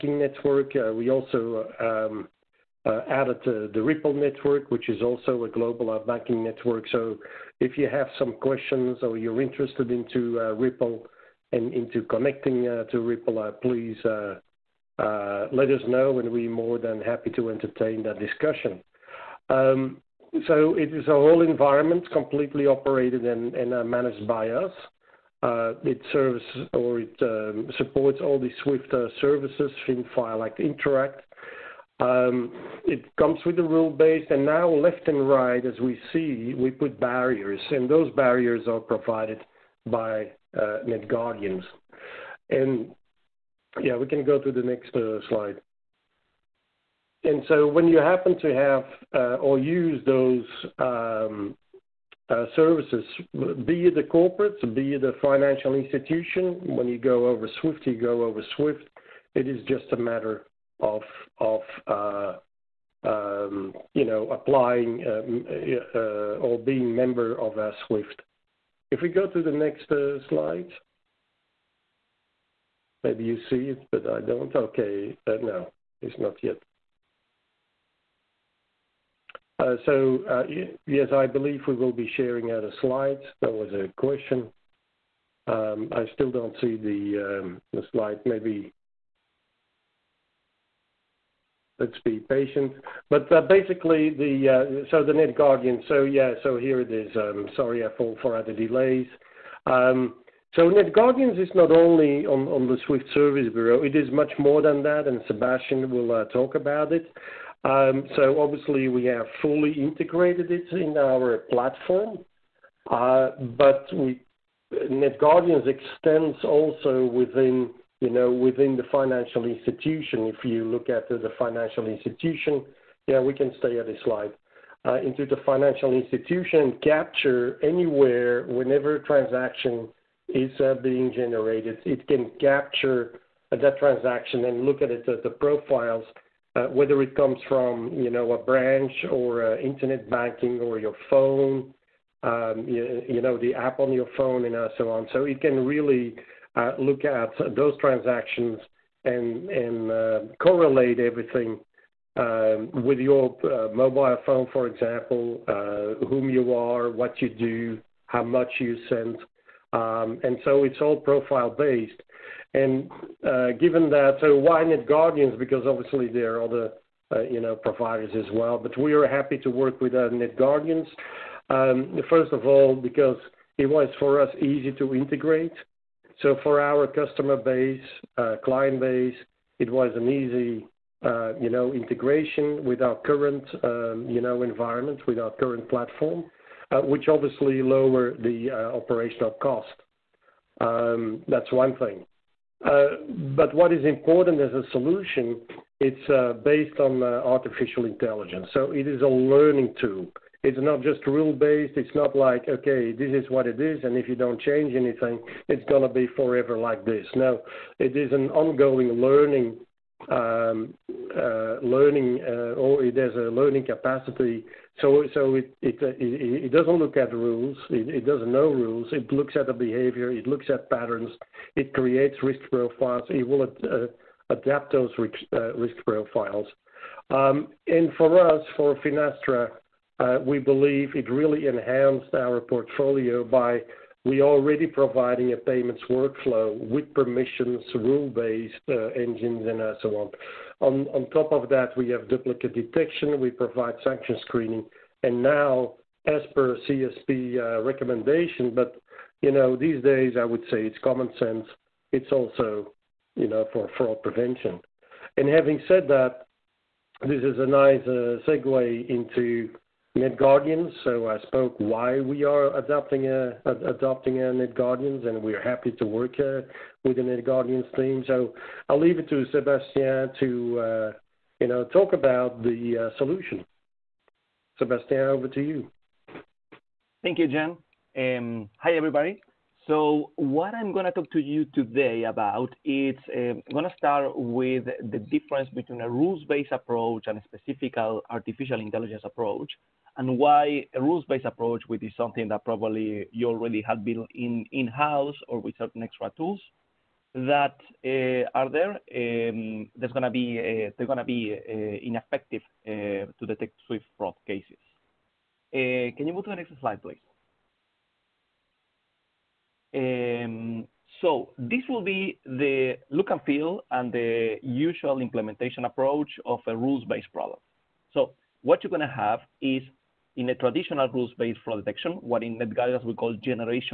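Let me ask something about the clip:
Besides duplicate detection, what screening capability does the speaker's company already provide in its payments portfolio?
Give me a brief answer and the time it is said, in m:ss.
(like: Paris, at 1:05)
Sanction screening, at 4:03.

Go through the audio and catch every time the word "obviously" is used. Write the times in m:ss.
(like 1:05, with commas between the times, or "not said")
1:48, 2:45, 3:07.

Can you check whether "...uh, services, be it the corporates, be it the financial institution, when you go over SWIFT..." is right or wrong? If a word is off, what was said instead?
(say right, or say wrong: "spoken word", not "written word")
right.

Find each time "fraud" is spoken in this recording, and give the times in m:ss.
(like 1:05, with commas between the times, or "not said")
4:13, 5:03, 5:21.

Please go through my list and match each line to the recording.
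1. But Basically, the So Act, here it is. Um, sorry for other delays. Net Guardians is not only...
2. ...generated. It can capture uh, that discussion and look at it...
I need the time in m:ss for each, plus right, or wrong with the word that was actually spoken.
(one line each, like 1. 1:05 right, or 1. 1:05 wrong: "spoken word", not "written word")
1. 1:33 wrong: "Yeah", not "Act"
2. 2:11 wrong: "transaction", not "discussion".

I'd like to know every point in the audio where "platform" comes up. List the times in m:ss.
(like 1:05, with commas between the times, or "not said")
1:51, 3:05.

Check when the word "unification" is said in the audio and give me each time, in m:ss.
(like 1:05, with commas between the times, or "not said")
not said.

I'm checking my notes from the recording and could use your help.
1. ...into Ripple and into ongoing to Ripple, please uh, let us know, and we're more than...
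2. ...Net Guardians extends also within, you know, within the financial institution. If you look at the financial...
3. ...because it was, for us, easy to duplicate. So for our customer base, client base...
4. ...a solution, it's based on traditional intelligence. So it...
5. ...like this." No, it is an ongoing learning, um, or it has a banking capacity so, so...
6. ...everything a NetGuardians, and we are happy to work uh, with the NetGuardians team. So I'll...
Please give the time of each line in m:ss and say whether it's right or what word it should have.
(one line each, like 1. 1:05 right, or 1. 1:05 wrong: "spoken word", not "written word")
1. 0:09 wrong: "connecting", not "ongoing"
2. 1:54 right
3. 2:52 wrong: "integrate", not "duplicate"
4. 3:14 wrong: "artificial", not "traditional"
5. 3:26 wrong: "learning", not "banking"
6. 4:23 wrong: "adopting", not "everything".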